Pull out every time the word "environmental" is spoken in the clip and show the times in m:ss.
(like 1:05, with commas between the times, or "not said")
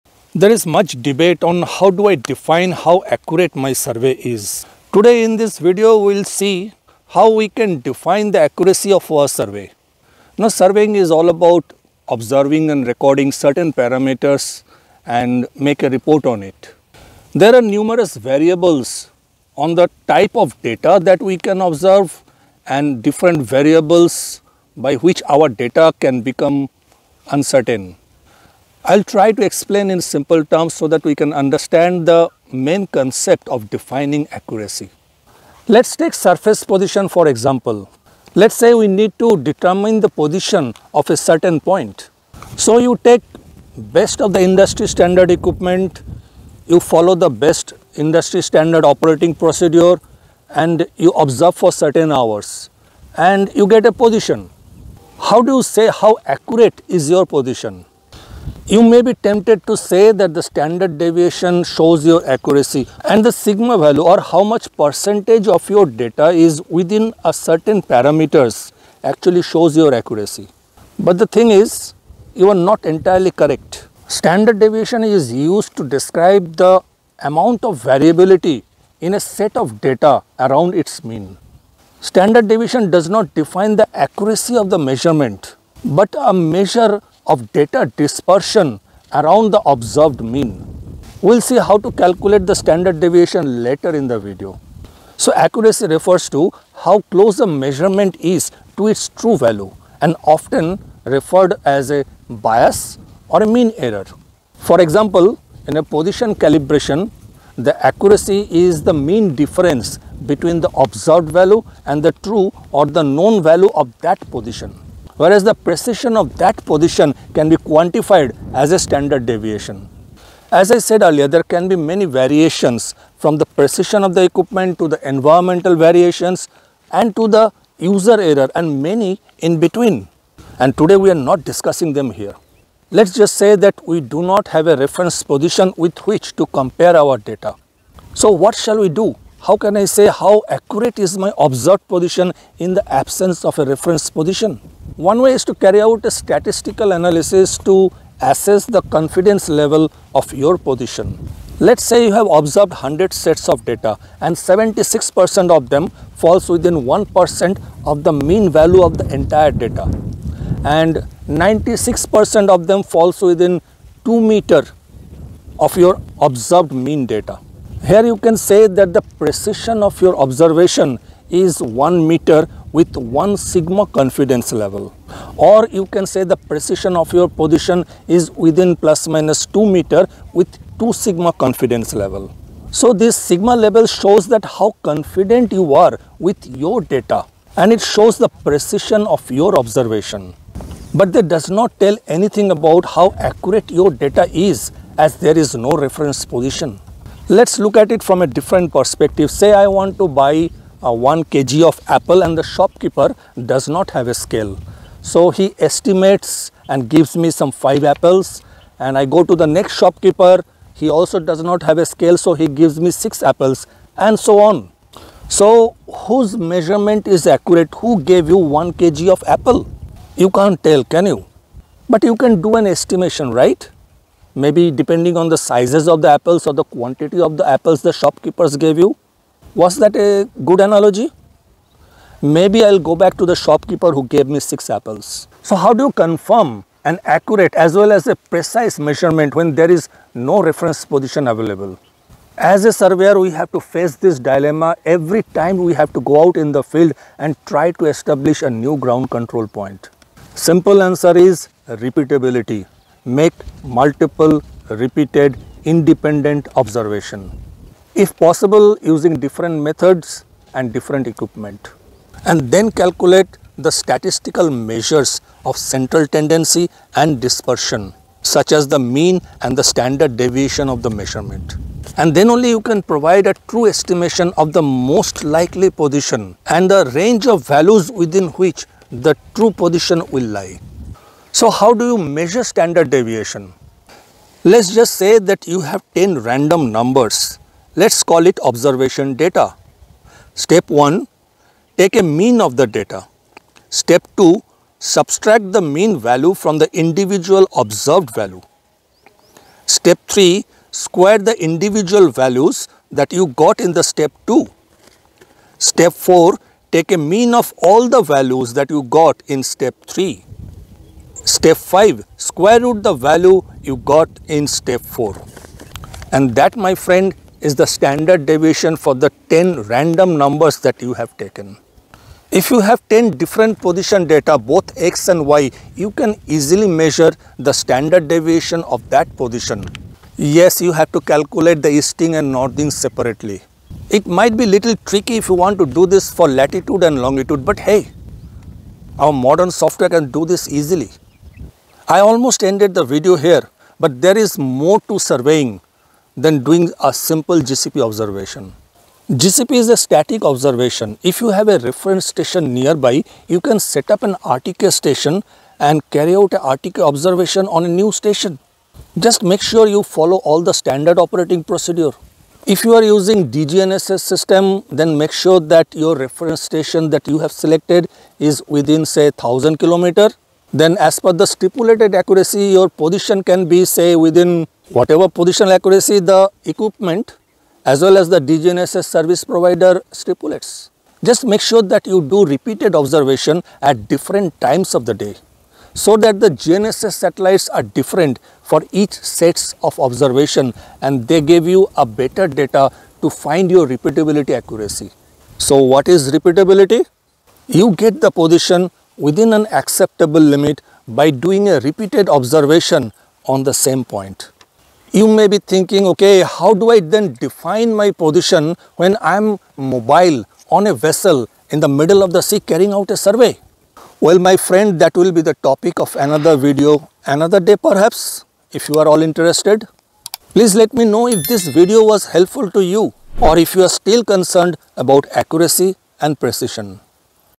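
2:05.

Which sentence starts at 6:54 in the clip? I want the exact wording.
Well, my friend, that will be the topic of another video, another day perhaps, if you are all interested.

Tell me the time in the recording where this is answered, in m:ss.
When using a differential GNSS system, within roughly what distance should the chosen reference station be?
6:09.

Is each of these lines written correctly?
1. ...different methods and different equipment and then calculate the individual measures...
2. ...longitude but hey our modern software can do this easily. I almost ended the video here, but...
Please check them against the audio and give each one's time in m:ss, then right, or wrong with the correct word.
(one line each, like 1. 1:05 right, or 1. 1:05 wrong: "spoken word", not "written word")
1. 4:19 wrong: "statistical", not "individual"
2. 5:36 right.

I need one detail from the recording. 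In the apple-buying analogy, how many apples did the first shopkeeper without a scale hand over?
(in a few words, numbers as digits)
5.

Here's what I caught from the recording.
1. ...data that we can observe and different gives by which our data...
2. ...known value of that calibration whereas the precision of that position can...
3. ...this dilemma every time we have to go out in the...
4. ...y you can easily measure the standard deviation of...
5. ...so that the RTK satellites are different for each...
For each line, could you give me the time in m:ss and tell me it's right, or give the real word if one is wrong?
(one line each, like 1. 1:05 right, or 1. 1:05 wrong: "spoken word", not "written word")
1. 0:20 wrong: "variables", not "gives"
2. 1:53 wrong: "position", not "calibration"
3. 4:03 right
4. 5:25 right
5. 6:25 wrong: "GNSS", not "RTK".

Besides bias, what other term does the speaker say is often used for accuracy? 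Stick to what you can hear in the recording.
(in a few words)
mean error.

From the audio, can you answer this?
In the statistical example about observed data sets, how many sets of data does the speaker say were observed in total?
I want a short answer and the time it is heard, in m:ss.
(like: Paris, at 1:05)
100, at 2:32.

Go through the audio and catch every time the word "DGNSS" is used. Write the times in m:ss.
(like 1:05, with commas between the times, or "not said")
6:03, 6:18.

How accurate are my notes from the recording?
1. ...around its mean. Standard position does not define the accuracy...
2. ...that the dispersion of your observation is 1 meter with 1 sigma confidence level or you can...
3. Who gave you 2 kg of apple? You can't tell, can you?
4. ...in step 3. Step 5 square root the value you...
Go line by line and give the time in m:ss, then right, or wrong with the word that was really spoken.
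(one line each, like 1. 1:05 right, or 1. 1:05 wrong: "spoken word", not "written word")
1. 1:20 wrong: "deviation", not "position"
2. 2:48 wrong: "precision", not "dispersion"
3. 3:37 wrong: "1", not "2"
4. 5:09 right.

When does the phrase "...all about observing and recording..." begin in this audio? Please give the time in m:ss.
0:11.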